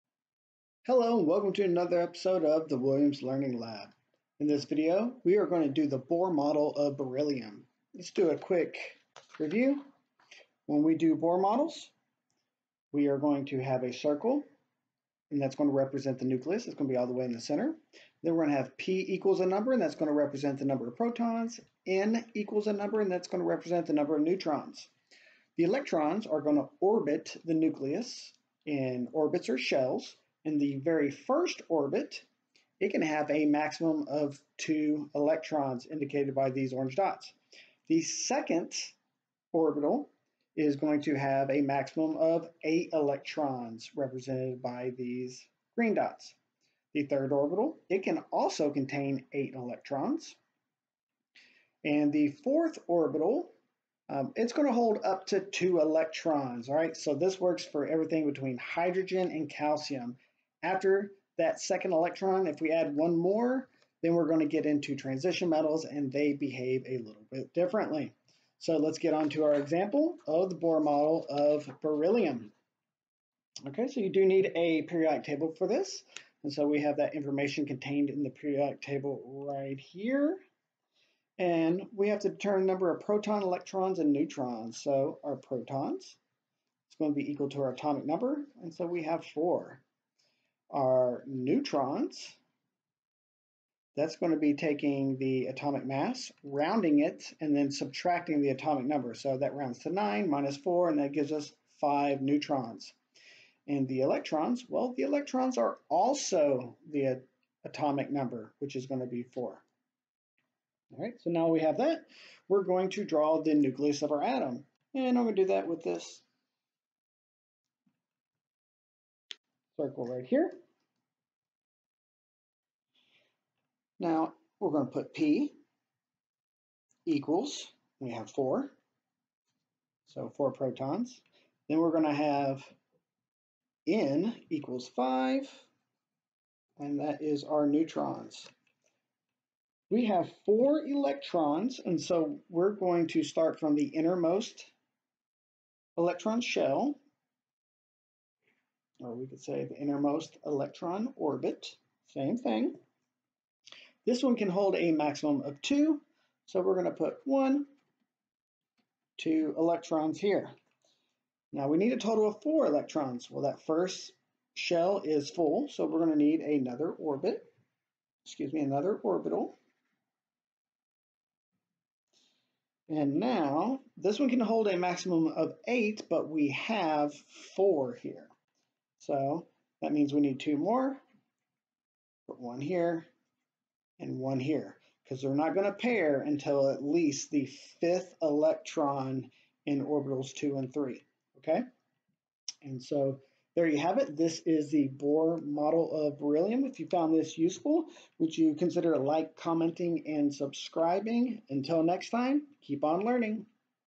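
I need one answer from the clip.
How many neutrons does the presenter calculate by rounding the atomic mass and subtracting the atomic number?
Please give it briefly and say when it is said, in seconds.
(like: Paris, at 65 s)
5, at 101 s.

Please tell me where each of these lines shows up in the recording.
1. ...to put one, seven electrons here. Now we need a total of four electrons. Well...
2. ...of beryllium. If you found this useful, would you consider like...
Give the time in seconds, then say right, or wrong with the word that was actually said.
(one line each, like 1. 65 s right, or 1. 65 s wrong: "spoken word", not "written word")
1. 156 s wrong: "two", not "seven"
2. 196 s right.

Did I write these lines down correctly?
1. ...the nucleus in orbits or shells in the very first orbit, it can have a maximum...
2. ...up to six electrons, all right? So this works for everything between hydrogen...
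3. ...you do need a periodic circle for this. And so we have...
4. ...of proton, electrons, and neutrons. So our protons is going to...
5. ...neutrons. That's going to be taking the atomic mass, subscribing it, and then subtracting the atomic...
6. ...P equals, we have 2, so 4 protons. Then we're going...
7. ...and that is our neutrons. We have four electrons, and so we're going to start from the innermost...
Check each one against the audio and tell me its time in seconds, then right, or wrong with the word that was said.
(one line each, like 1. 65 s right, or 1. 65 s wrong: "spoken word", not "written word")
1. 27 s right
2. 55 s wrong: "two", not "six"
3. 74 s wrong: "table", not "circle"
4. 82 s right
5. 91 s wrong: "rounding", not "subscribing"
6. 125 s wrong: "4", not "2"
7. 136 s right.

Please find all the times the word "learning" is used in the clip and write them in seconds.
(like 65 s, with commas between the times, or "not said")
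3 s, 203 s.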